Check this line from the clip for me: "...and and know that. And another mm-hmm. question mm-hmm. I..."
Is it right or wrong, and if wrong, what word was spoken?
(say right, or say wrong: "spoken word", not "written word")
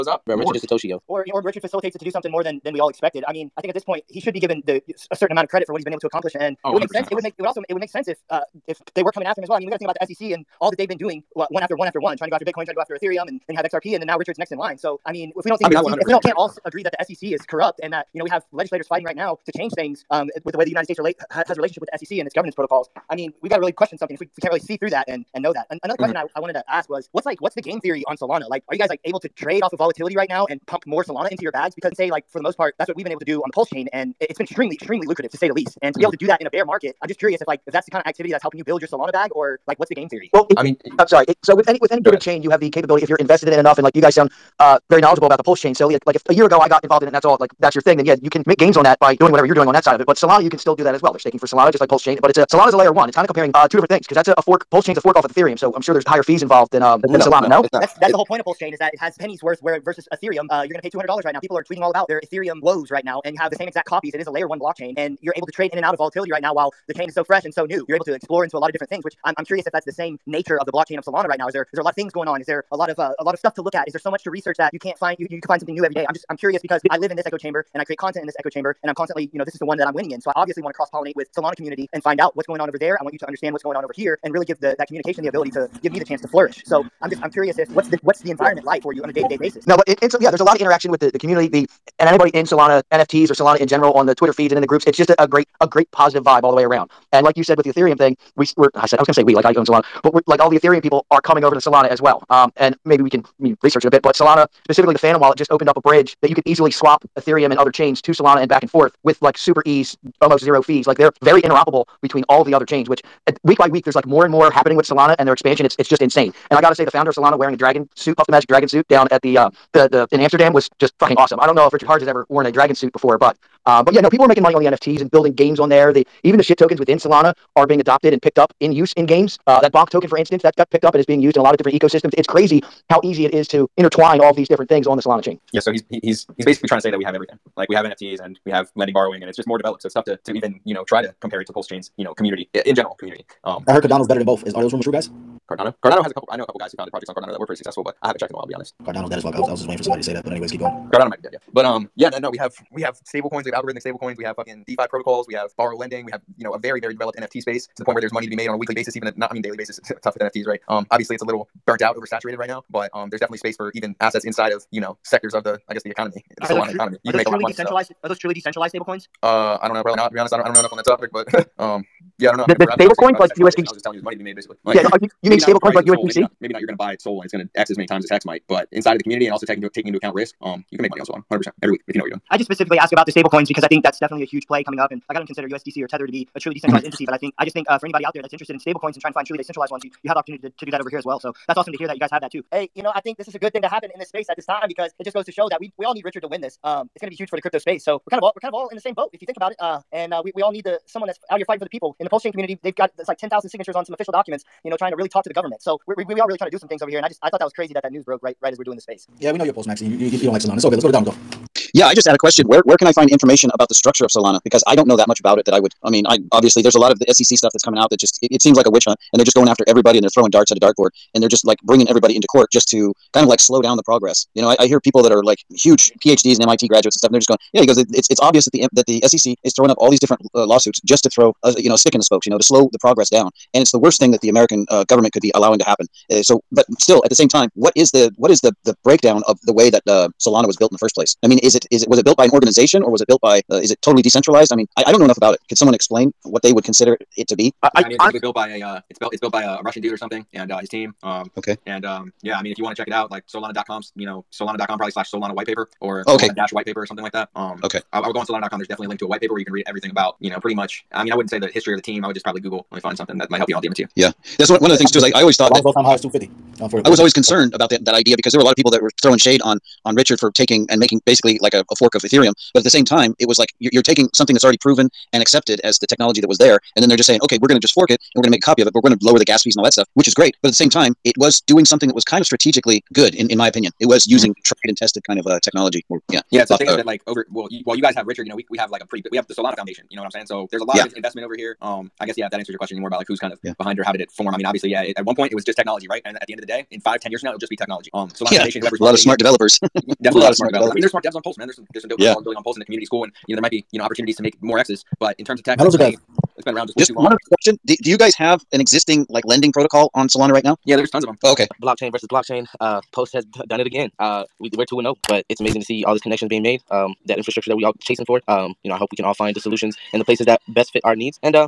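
right.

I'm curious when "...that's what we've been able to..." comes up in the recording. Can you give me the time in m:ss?
0:32.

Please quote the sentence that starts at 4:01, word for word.
I mean, is it is it was it built by an organization or was it built by uh, is it totally decentralized?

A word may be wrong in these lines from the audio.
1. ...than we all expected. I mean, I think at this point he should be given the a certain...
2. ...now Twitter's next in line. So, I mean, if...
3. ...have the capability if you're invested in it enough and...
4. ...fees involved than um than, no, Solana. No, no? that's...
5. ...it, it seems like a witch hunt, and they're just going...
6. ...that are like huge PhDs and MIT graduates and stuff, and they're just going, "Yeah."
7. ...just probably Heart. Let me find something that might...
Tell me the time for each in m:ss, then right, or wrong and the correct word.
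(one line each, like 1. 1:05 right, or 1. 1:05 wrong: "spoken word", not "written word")
1. 0:02 right
2. 0:14 wrong: "Richard", not "Twitter"
3. 0:42 right
4. 0:56 right
5. 3:38 right
6. 3:45 right
7. 4:22 wrong: "Google", not "Heart".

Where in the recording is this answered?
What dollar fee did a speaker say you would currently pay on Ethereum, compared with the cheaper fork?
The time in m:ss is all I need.
1:00.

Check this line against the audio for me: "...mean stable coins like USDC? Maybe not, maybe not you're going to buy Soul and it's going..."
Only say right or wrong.
right.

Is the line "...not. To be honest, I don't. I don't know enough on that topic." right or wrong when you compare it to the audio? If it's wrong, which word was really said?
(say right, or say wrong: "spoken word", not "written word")
right.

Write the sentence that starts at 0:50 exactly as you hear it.
But Solana, you can still do that as well.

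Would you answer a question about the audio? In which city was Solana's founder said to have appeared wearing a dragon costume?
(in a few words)
Amsterdam.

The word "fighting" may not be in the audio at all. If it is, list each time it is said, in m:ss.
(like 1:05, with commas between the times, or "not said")
0:18, 3:21.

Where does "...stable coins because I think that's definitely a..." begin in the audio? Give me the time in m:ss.
3:03.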